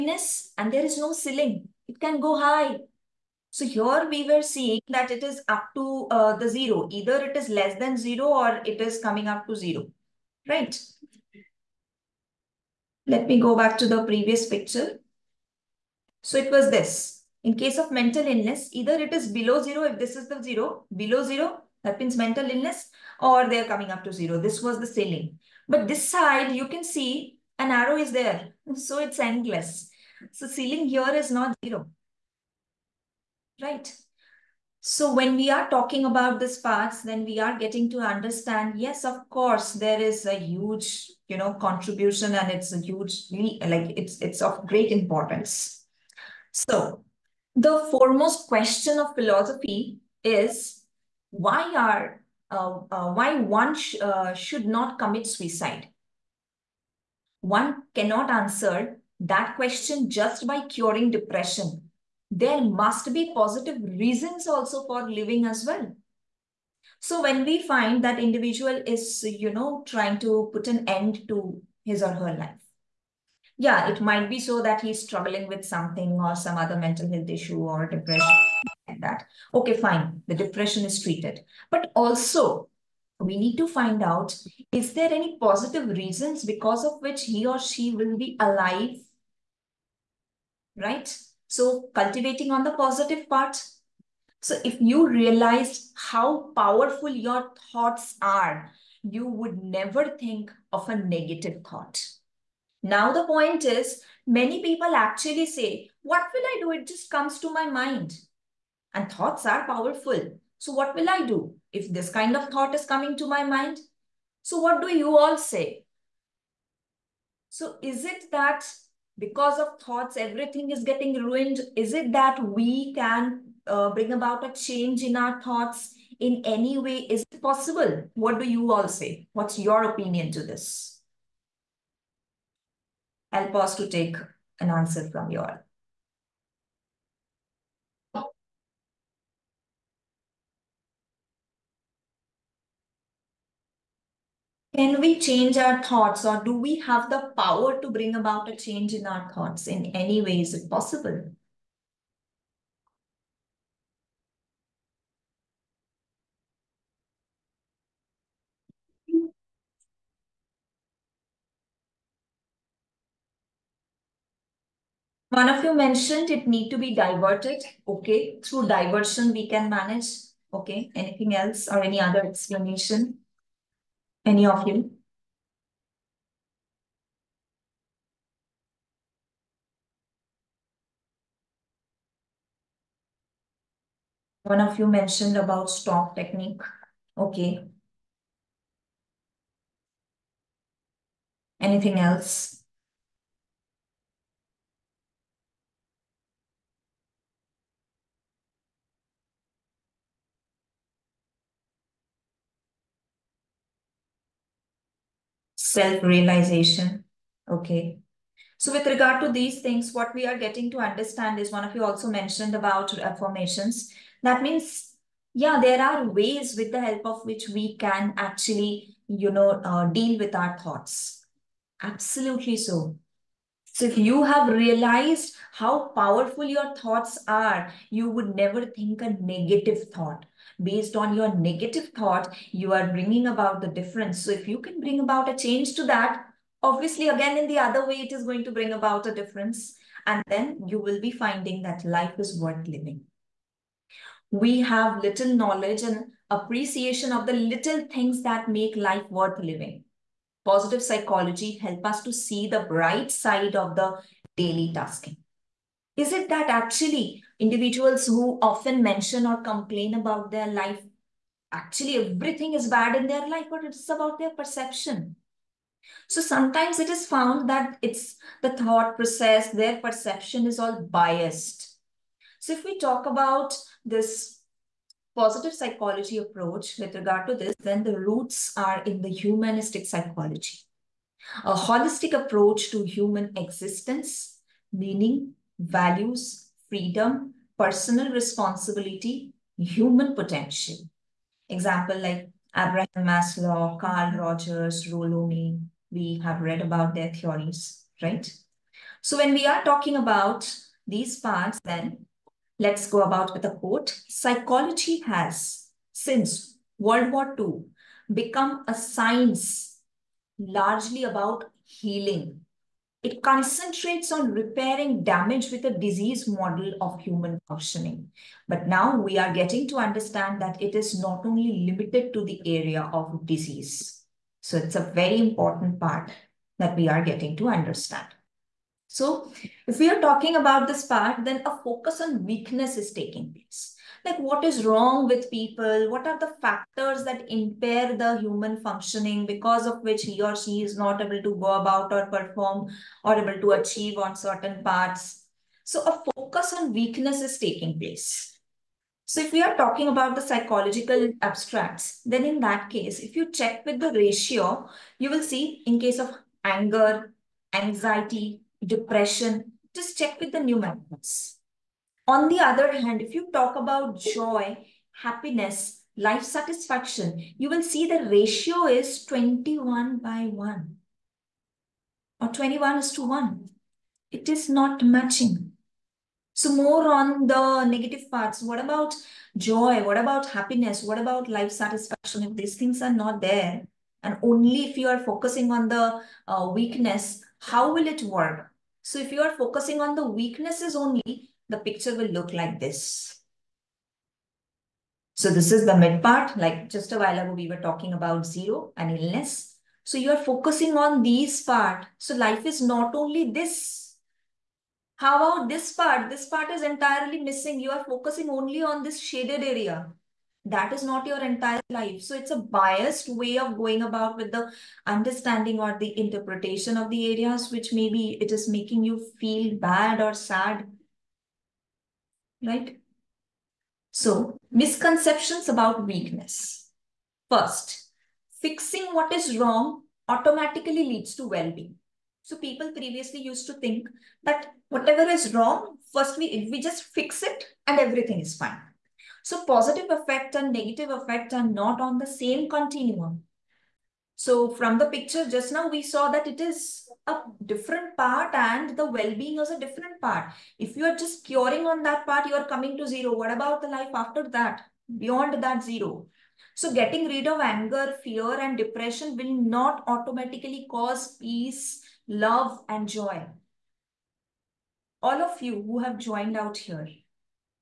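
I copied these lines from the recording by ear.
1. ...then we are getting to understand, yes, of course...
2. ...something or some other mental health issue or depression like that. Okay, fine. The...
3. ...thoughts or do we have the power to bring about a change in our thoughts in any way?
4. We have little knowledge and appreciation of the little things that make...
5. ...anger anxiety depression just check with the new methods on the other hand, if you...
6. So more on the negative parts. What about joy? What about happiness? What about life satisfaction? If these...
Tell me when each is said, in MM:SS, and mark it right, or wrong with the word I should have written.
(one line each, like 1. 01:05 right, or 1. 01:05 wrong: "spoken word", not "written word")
1. 00:37 right
2. 01:15 right
3. 02:25 right
4. 04:04 right
5. 05:56 right
6. 06:16 right.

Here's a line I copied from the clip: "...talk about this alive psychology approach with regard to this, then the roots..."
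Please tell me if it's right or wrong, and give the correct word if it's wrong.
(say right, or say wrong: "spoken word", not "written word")
wrong: "positive", not "alive".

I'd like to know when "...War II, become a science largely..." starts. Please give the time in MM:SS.
05:07.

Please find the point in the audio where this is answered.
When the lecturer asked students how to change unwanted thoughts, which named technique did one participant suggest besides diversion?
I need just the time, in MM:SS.
03:05.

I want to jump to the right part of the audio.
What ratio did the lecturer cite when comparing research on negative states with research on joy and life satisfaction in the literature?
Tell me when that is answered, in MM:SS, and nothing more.
06:12.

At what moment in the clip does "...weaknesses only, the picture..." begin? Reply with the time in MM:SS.
06:30.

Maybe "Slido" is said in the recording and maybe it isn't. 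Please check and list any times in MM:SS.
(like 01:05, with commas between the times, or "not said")
not said.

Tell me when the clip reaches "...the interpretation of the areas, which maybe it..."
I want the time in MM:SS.
06:55.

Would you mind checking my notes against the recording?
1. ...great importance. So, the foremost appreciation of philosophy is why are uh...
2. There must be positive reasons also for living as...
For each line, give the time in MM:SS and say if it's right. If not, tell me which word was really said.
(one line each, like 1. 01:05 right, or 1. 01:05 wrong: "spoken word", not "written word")
1. 00:44 wrong: "question", not "appreciation"
2. 01:02 right.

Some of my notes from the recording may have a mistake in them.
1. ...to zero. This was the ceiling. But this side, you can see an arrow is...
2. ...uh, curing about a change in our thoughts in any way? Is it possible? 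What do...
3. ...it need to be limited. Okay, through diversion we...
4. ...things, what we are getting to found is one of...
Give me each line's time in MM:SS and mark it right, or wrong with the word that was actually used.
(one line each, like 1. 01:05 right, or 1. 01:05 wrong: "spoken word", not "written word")
1. 00:24 right
2. 02:03 wrong: "bring", not "curing"
3. 02:46 wrong: "diverted", not "limited"
4. 03:29 wrong: "understand", not "found".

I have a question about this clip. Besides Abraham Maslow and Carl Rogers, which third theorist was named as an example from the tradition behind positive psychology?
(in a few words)
Rollo May.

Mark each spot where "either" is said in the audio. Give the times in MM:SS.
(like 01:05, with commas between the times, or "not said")
00:06, 00:18.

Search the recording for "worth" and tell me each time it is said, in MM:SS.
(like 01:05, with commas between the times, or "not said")
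04:02, 04:09.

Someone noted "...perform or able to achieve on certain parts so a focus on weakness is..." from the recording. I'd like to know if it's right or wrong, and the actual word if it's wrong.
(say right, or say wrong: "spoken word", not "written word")
right.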